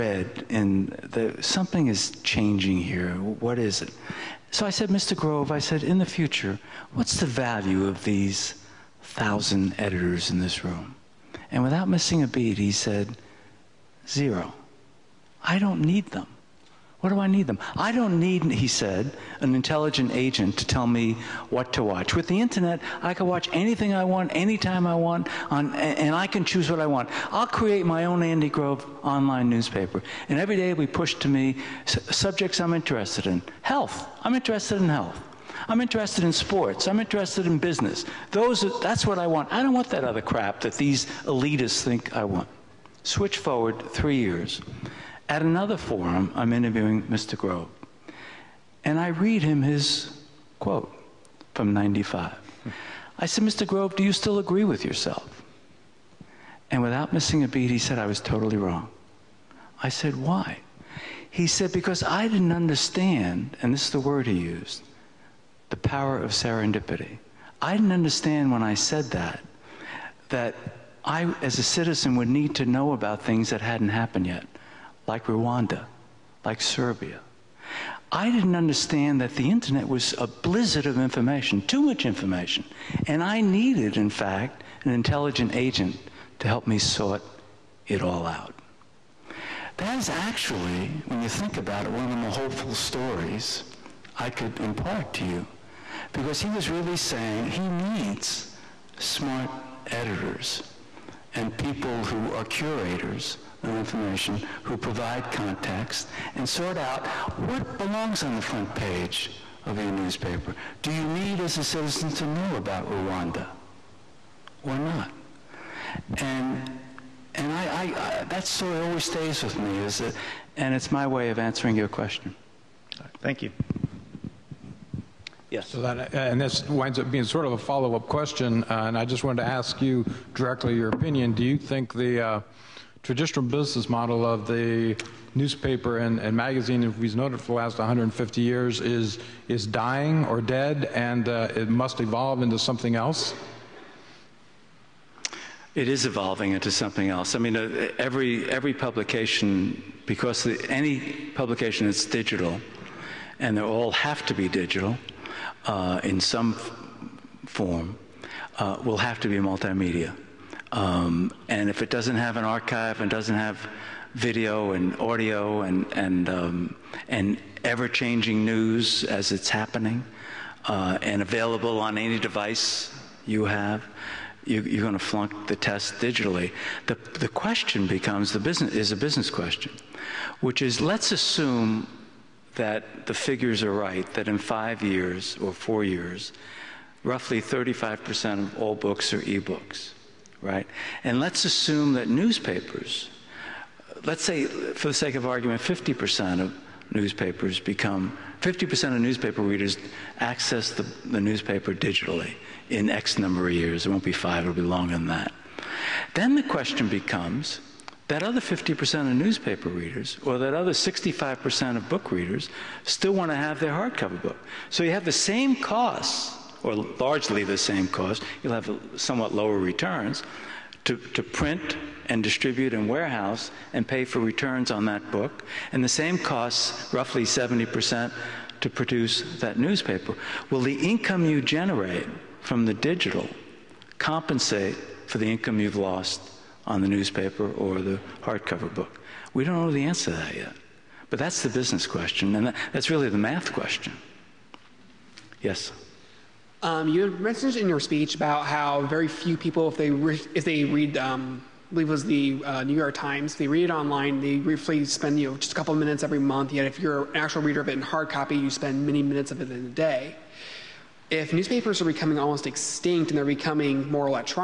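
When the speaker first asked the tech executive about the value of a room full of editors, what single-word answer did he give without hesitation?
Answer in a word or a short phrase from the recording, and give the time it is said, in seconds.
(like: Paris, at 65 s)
zero, at 14 s.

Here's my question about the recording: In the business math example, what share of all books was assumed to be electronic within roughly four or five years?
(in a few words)
35%.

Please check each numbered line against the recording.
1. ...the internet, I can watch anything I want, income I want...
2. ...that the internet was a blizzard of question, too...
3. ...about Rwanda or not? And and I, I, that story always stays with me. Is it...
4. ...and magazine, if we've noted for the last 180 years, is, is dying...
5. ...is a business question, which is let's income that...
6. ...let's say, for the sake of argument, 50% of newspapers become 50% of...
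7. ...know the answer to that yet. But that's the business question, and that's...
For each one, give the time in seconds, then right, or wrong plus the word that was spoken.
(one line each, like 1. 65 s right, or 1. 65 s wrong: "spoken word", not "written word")
1. 22 s wrong: "anytime", not "income"
2. 79 s wrong: "information", not "question"
3. 112 s right
4. 136 s wrong: "150", not "180"
5. 178 s wrong: "assume", not "income"
6. 194 s right
7. 239 s right.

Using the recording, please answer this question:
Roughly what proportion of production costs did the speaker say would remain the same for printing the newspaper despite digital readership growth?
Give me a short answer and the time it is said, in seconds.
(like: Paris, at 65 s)
70%, at 227 s.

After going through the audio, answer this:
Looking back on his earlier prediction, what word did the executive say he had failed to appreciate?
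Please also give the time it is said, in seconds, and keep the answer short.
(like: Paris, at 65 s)
serendipity, at 66 s.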